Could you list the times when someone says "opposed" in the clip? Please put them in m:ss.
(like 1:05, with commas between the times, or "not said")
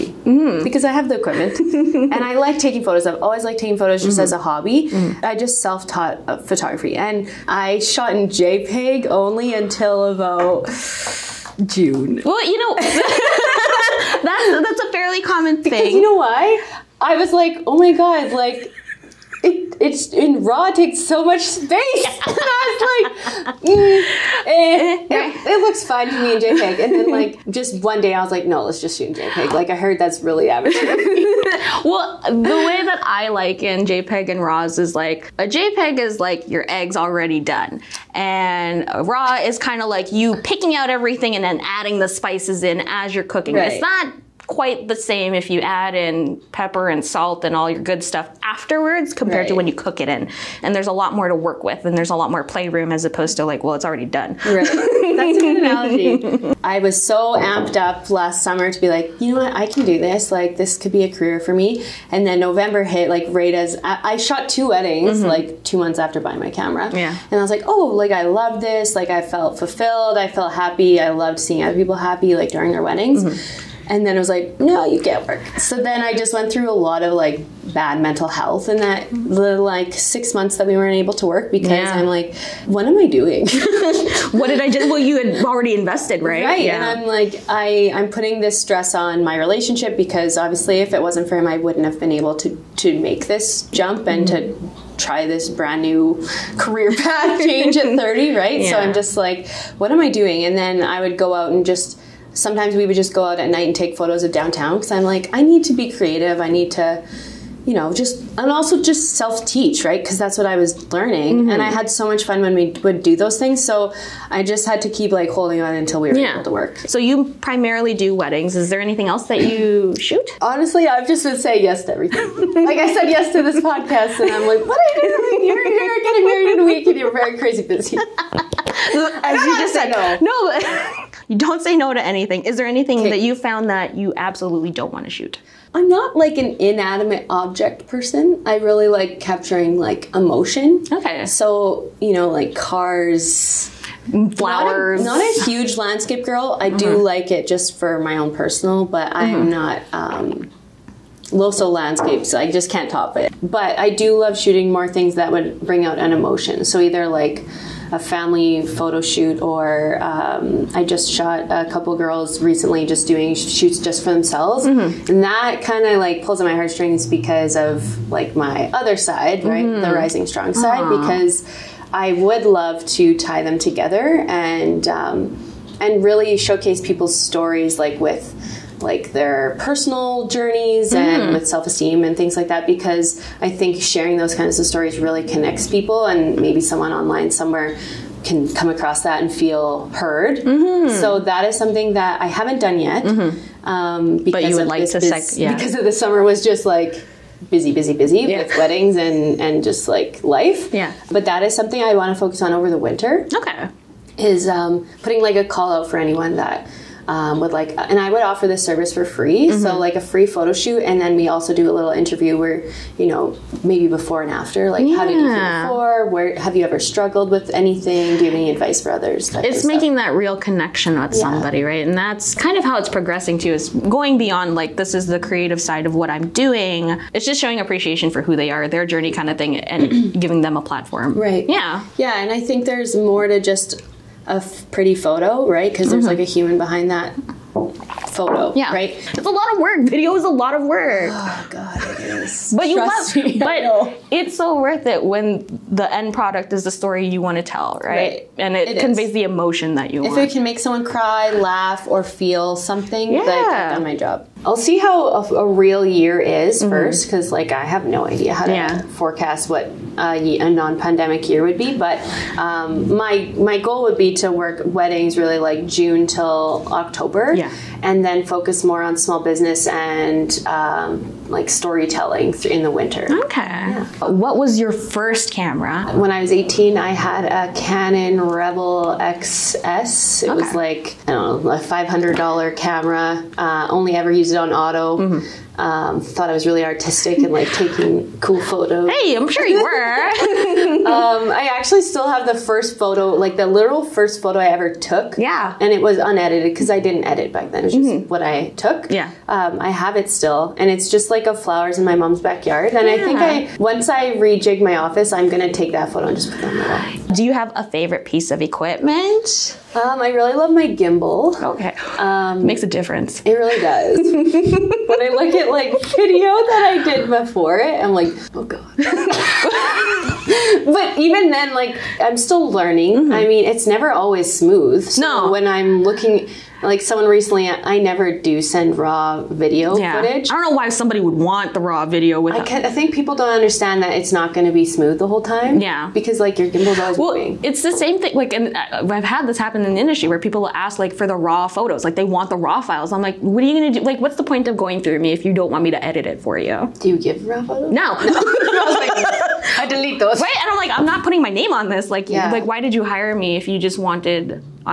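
0:53.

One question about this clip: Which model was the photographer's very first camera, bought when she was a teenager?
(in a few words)
Canon Rebel XS.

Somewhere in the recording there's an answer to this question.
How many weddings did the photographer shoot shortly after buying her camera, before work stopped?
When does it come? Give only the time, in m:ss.
1:04.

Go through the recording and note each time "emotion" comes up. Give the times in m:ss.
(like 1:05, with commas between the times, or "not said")
2:20, 2:36, 4:09.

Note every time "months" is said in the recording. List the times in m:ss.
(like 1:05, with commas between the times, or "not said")
1:05, 1:20.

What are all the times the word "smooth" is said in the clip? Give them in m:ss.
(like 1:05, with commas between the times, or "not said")
5:24, 5:34.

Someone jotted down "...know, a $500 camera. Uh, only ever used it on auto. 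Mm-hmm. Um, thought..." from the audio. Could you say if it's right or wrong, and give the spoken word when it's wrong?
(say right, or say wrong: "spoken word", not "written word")
right.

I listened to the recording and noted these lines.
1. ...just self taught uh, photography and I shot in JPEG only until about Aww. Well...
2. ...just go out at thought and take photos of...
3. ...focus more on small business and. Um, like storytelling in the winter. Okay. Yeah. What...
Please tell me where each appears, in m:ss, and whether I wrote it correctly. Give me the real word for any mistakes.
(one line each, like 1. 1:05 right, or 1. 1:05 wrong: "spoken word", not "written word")
1. 0:05 wrong: "June", not "Aww"
2. 1:42 wrong: "night", not "thought"
3. 4:28 right.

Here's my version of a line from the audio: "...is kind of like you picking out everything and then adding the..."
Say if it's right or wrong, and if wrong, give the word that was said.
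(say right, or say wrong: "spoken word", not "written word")
right.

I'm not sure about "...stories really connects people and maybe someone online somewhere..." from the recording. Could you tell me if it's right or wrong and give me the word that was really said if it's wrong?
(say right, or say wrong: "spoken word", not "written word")
right.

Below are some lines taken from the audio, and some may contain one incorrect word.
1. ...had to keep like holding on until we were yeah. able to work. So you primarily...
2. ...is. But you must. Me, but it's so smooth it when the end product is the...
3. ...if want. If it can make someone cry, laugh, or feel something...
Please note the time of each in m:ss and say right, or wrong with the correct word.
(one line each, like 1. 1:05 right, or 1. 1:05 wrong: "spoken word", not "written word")
1. 1:54 right
2. 4:02 wrong: "worth", not "smooth"
3. 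4:10 right.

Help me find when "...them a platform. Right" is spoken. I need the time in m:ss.
3:50.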